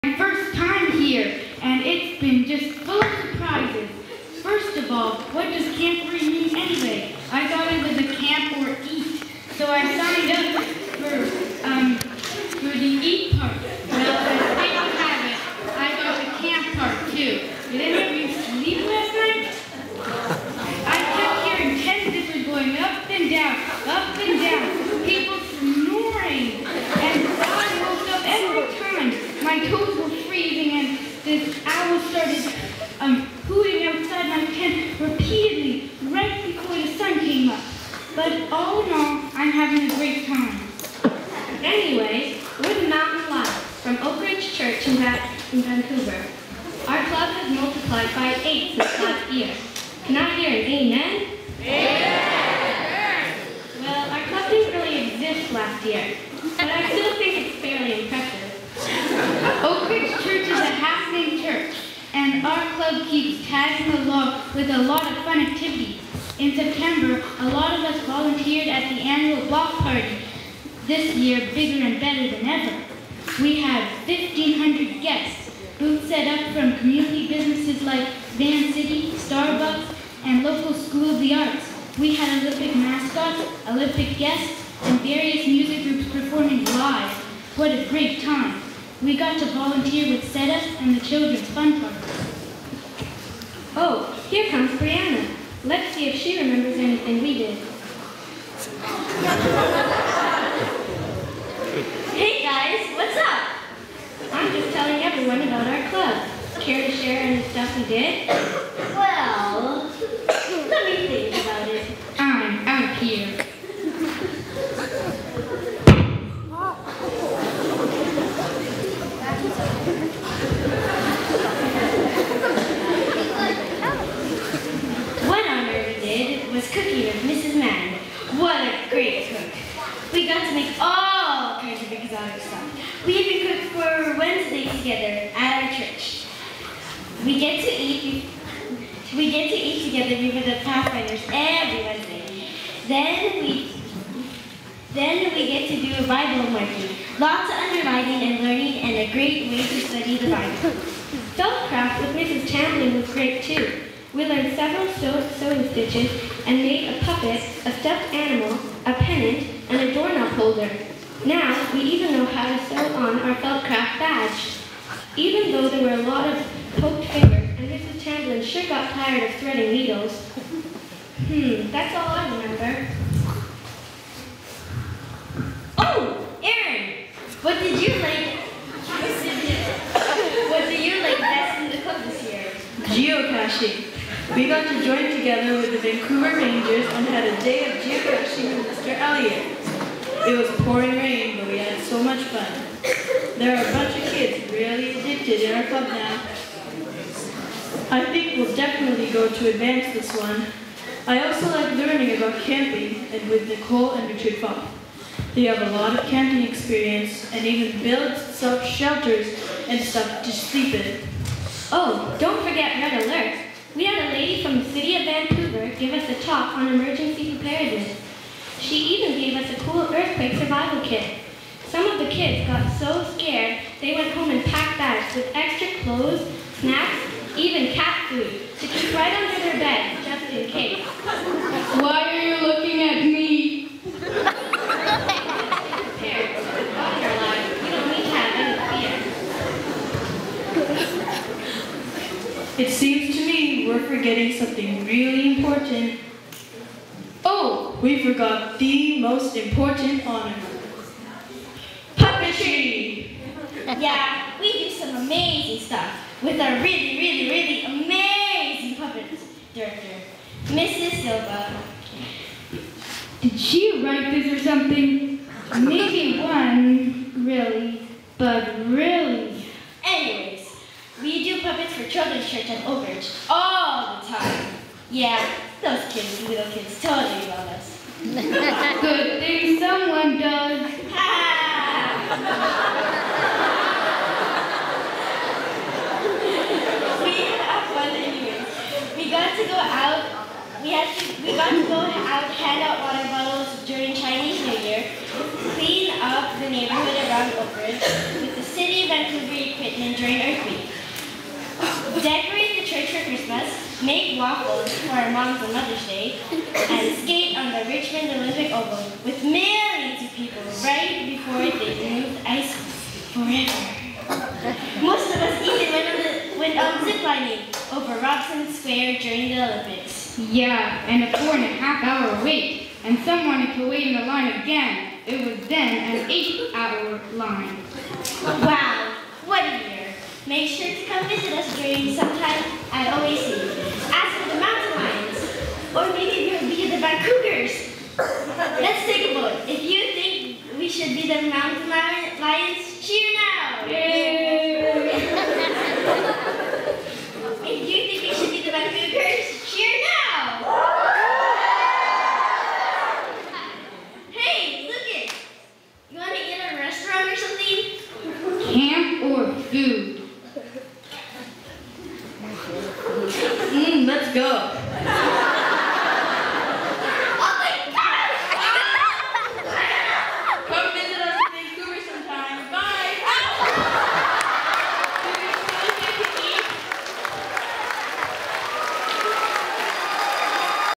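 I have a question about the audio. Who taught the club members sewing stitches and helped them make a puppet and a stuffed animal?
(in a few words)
Mrs. Tamlin.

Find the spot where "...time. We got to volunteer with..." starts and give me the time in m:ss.
1:28.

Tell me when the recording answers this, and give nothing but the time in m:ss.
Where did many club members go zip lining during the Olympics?
5:18.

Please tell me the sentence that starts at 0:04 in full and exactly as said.
First of all, what does camp mean anyway?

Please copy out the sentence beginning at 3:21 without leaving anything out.
I also like learning about camping and with Nicole and Richard Fopp.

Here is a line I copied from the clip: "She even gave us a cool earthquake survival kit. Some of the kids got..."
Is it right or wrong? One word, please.
right.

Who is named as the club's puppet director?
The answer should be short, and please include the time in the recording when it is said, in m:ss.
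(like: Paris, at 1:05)
Mrs. Silva, at 4:20.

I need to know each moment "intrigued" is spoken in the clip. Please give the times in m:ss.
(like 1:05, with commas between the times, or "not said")
not said.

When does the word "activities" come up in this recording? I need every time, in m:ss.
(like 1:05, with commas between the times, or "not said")
1:05.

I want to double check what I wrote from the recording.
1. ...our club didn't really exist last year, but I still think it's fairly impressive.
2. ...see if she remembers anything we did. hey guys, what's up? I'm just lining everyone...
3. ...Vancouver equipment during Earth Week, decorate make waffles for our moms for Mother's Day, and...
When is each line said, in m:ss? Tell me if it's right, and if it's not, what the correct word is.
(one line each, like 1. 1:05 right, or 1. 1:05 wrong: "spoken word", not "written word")
1. 0:54 right
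2. 1:35 wrong: "telling", not "lining"
3. 4:58 right.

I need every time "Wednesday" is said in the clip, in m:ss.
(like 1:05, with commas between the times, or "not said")
2:14, 2:21.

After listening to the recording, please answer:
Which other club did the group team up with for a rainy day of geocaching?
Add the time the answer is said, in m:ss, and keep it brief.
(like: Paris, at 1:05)
Vancouver Rangers, at 3:05.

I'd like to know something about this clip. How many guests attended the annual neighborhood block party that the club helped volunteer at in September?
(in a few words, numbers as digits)
1,500.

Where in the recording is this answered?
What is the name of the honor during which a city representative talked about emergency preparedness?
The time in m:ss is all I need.
3:32.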